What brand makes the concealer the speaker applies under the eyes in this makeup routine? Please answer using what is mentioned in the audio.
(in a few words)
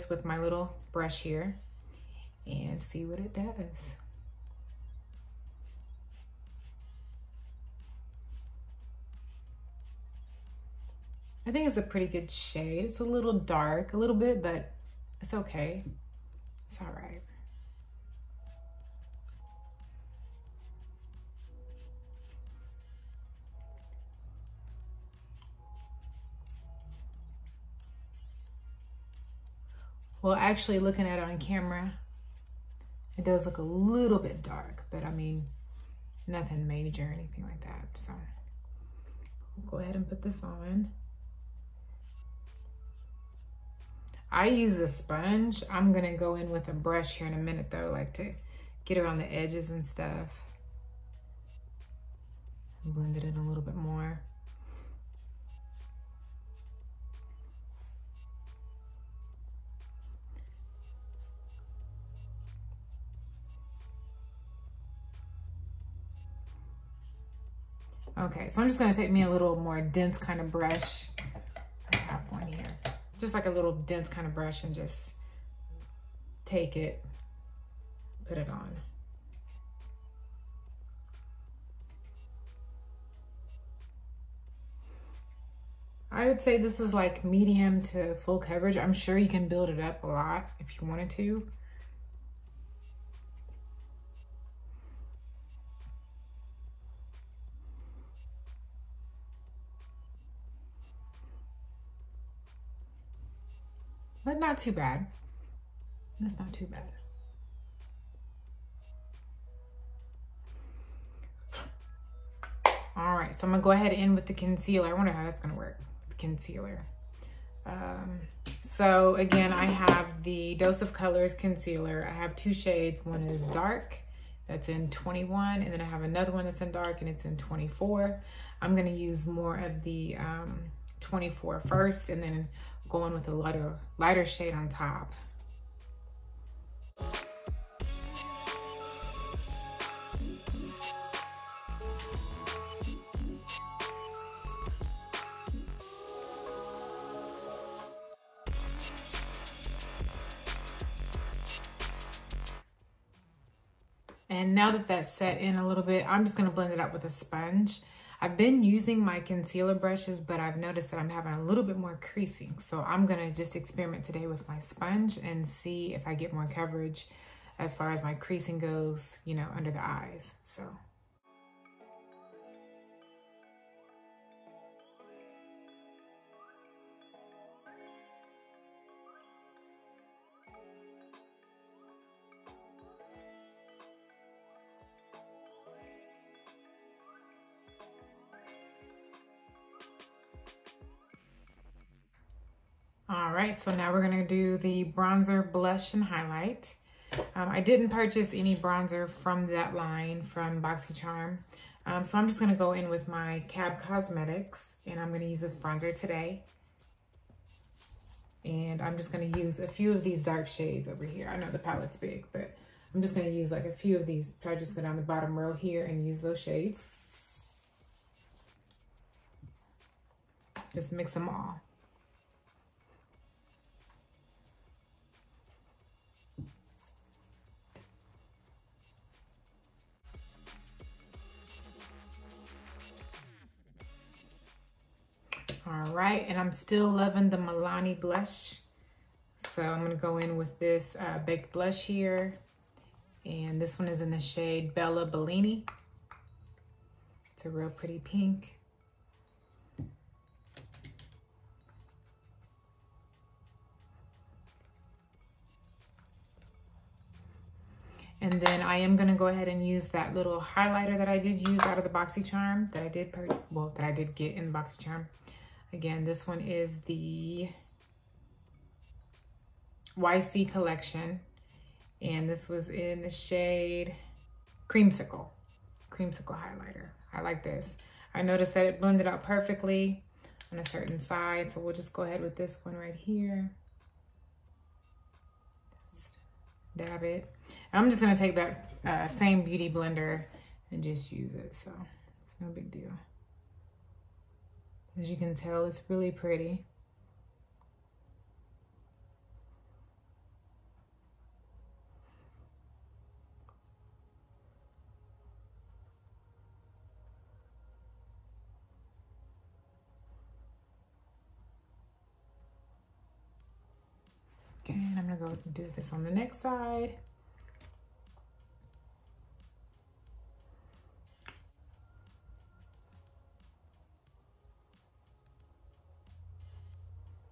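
Dose of Colors.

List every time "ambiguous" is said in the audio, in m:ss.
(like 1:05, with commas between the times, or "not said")
not said.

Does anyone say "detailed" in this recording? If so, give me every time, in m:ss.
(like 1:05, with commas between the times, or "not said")
not said.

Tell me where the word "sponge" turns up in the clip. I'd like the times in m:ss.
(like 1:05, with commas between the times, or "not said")
0:44, 2:37, 2:44.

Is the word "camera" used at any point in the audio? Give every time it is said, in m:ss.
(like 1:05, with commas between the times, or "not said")
0:31.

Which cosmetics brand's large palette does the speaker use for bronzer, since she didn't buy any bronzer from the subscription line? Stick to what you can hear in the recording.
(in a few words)
Cab Cosmetics.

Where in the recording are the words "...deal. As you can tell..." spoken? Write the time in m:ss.
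4:52.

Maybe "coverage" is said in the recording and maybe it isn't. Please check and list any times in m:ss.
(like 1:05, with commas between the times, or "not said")
1:28, 2:46.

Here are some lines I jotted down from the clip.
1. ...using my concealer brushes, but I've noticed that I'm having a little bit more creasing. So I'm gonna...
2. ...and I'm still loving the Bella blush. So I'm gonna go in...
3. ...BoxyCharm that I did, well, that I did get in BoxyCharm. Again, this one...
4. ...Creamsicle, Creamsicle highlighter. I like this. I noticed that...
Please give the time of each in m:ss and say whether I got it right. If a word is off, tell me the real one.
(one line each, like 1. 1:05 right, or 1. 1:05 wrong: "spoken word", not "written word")
1. 2:38 right
2. 3:56 wrong: "Milani", not "Bella"
3. 4:21 right
4. 4:34 right.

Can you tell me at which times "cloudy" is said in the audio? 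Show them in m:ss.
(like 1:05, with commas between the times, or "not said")
not said.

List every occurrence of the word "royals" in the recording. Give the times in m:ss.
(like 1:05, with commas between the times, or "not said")
not said.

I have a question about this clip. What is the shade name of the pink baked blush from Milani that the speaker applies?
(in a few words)
Bella Bellini.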